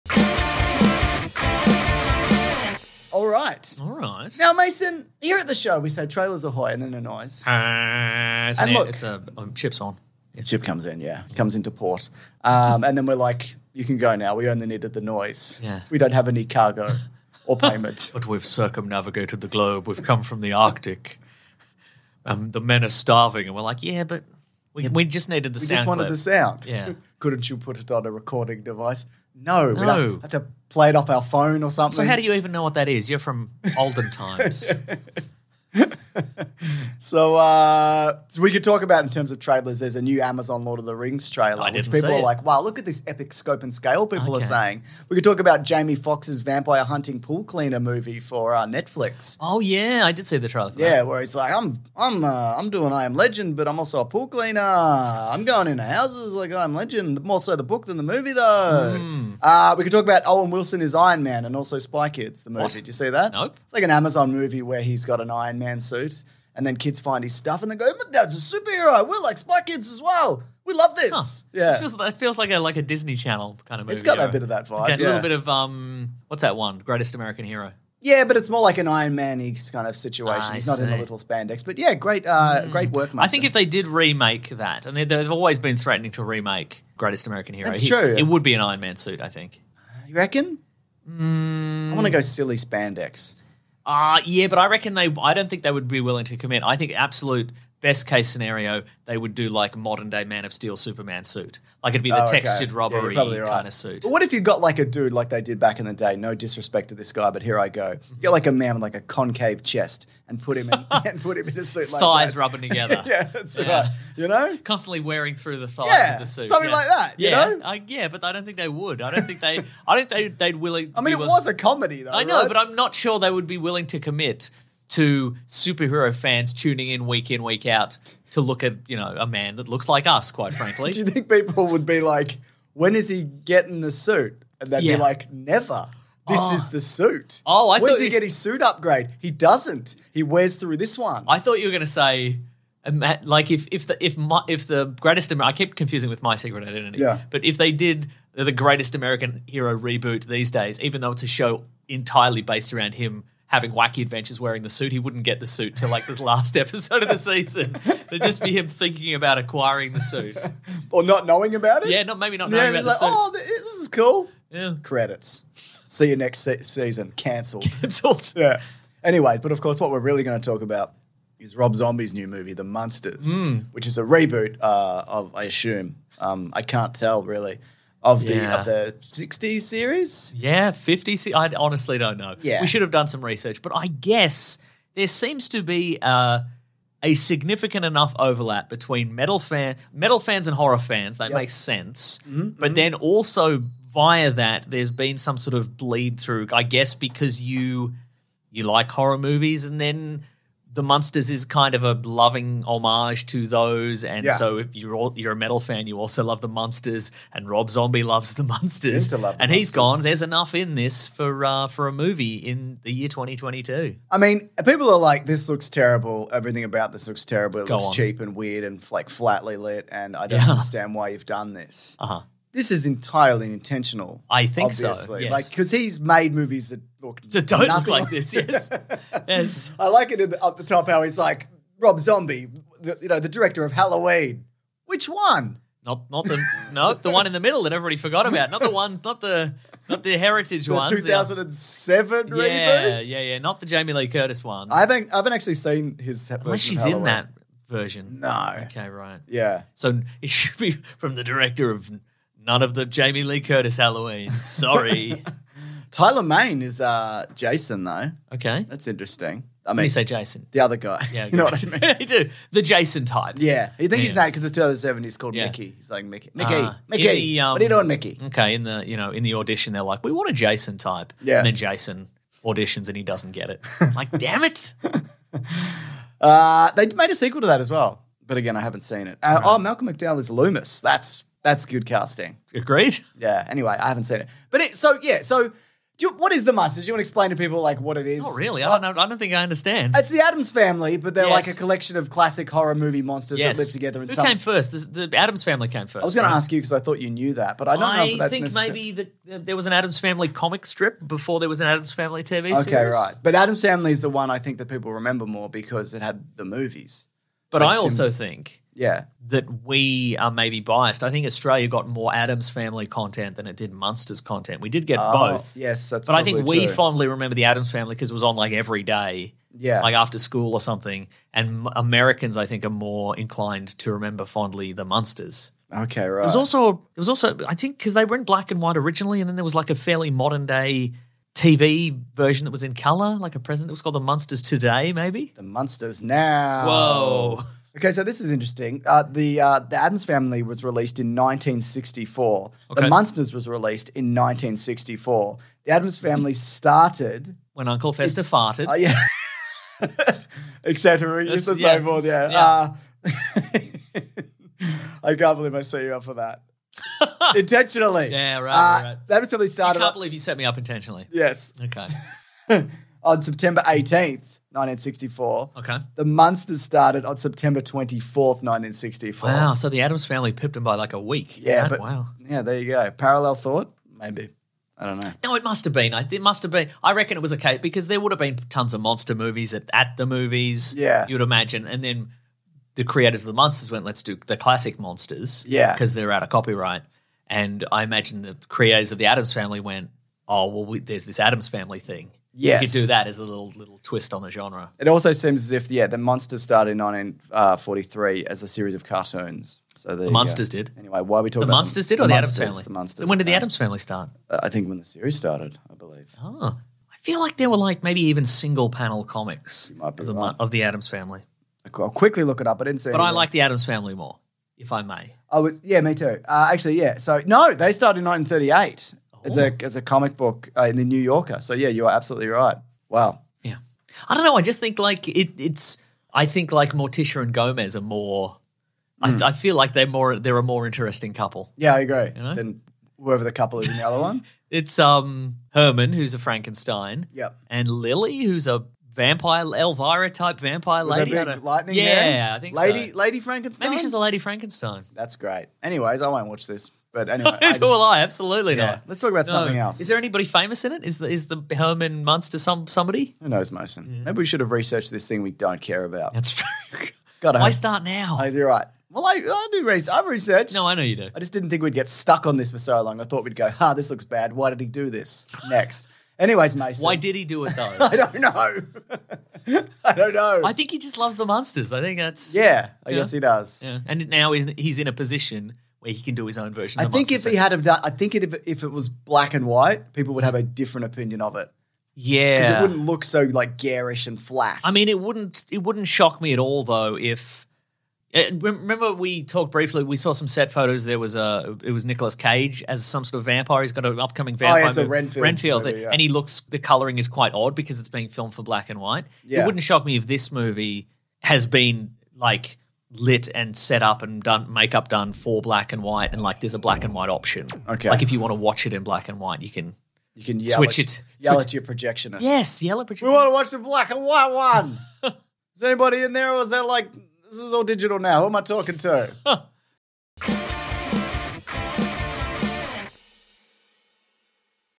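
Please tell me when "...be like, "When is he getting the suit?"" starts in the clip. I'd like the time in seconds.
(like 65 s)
131 s.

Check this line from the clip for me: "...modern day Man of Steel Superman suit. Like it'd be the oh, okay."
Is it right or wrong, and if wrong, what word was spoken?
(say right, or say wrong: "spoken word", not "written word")
right.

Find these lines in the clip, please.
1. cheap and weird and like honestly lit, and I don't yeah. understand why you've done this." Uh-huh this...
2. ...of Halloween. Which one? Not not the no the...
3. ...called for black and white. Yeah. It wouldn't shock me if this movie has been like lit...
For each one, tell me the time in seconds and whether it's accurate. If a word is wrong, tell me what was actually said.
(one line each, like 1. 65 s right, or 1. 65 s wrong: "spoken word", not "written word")
1. 217 s wrong: "flatly", not "honestly"
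2. 233 s right
3. 498 s wrong: "filmed", not "called".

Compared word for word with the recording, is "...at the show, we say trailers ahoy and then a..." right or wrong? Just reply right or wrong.
right.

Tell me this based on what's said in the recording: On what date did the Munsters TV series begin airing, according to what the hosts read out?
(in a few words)
September 24th, 1964.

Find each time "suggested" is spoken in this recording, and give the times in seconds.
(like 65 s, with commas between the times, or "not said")
not said.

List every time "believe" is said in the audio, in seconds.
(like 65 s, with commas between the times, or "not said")
355 s, 359 s, 405 s.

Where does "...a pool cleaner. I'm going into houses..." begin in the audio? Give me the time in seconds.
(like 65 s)
54 s.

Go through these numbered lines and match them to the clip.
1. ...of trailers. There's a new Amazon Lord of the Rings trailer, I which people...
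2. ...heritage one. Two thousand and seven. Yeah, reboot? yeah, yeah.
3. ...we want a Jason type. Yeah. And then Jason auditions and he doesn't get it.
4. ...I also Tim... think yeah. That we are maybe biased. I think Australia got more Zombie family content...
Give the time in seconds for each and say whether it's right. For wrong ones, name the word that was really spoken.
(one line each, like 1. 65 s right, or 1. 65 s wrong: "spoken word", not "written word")
1. 39 s right
2. 240 s right
3. 270 s right
4. 307 s wrong: "Addams", not "Zombie".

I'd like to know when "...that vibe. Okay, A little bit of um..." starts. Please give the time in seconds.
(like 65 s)
74 s.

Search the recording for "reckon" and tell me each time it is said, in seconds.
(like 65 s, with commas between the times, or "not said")
90 s, 94 s, 376 s.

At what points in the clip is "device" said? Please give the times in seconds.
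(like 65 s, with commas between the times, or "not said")
28 s.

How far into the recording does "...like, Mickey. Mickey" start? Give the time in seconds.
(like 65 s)
265 s.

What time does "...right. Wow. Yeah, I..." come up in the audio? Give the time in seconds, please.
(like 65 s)
422 s.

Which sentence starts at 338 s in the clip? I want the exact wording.
Uh, the uh, the Addams Family was released in 1964.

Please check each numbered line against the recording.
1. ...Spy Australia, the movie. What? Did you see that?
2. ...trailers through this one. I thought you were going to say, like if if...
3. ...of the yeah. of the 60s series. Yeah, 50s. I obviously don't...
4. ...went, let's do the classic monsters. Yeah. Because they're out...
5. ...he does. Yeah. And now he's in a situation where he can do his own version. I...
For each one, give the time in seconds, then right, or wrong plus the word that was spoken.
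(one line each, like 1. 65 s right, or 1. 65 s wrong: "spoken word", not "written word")
1. 61 s wrong: "Kids", not "Australia"
2. 140 s wrong: "wears", not "trailers"
3. 178 s wrong: "honestly", not "obviously"
4. 383 s right
5. 473 s wrong: "position", not "situation".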